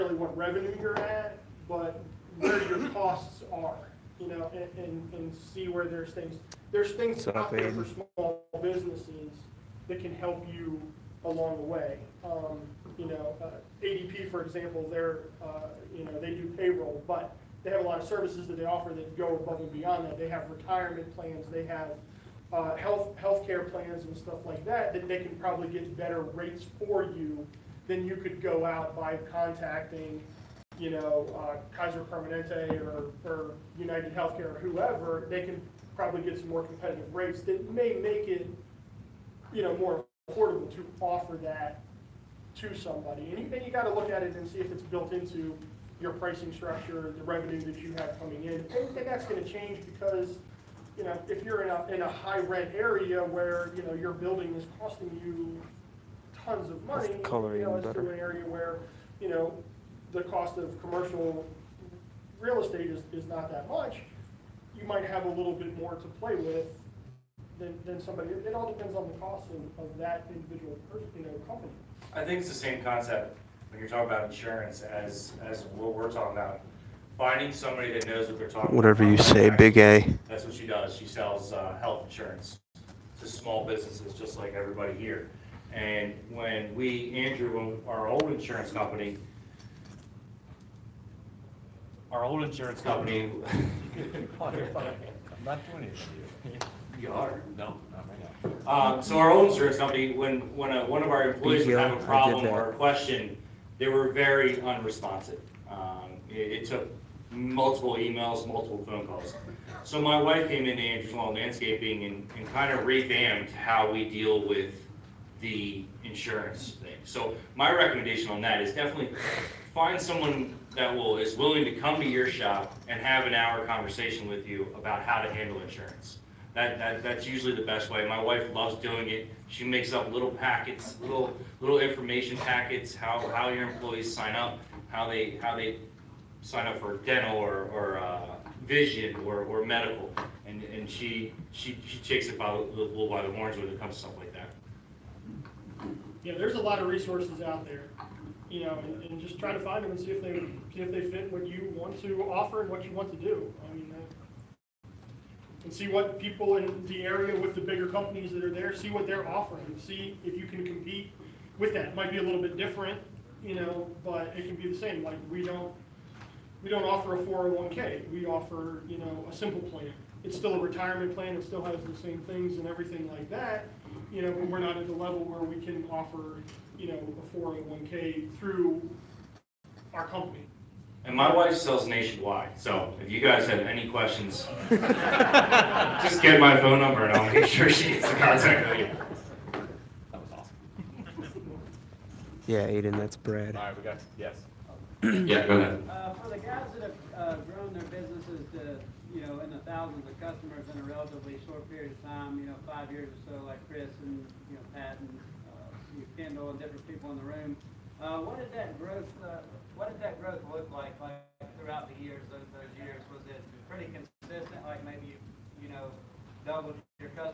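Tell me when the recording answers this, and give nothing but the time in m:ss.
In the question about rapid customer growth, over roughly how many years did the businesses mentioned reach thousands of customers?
3:22.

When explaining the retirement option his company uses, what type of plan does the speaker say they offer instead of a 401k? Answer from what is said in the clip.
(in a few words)
a simple plan.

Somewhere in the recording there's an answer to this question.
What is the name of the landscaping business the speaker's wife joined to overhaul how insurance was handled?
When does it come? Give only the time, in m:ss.
1:50.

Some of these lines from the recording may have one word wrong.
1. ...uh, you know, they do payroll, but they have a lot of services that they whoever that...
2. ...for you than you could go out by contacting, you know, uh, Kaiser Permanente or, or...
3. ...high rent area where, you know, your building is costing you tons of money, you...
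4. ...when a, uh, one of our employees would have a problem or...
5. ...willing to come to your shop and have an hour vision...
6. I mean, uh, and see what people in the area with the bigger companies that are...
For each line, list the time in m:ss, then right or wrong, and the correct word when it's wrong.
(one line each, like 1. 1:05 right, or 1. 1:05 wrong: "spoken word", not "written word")
1. 0:15 wrong: "offer", not "whoever"
2. 0:26 right
3. 0:52 right
4. 1:40 right
5. 2:01 wrong: "conversation", not "vision"
6. 2:33 right.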